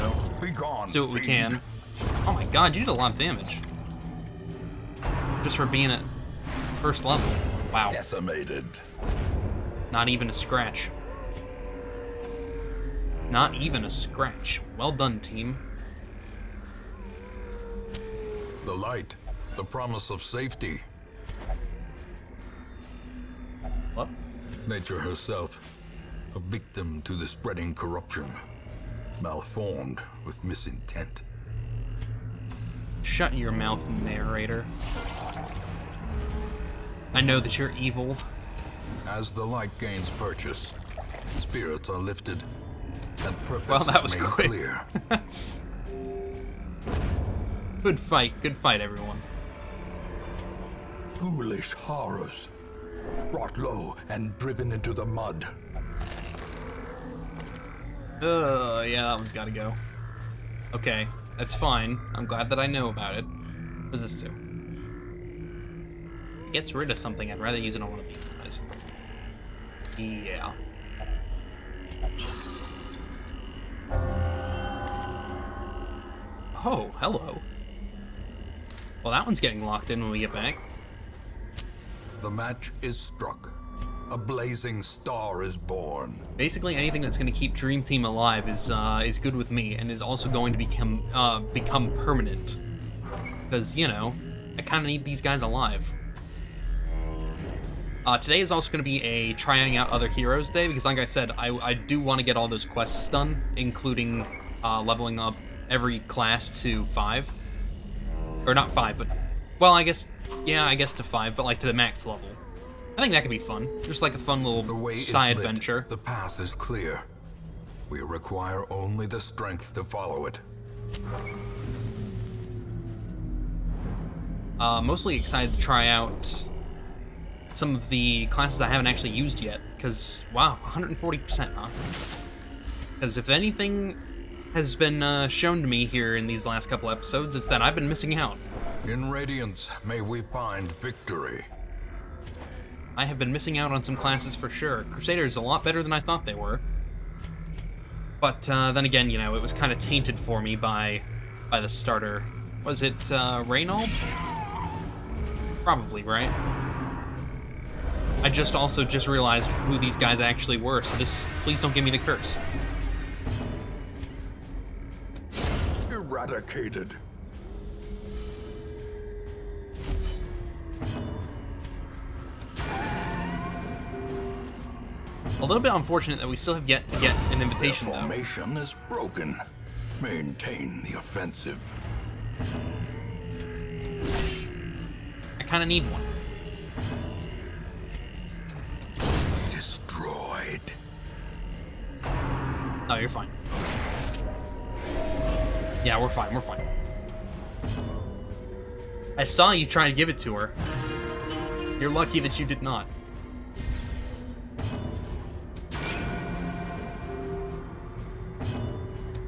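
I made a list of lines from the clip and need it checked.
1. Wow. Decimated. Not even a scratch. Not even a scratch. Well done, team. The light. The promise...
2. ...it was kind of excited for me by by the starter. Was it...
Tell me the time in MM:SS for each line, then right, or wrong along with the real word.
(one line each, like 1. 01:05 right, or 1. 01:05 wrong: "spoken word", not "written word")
1. 00:07 right
2. 02:29 wrong: "tainted", not "excited".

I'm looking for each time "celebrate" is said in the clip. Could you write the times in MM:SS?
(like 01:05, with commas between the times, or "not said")
not said.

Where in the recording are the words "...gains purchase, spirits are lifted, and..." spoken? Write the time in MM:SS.
00:39.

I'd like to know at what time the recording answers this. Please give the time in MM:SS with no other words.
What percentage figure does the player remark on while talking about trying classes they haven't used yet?
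02:10.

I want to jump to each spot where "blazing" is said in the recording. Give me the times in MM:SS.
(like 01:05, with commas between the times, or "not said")
01:24.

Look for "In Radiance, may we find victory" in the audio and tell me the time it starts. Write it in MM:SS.
02:18.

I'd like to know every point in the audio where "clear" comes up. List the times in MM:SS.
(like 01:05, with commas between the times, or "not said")
00:44, 01:56.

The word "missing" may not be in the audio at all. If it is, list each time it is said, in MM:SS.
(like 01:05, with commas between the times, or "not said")
02:17, 02:23.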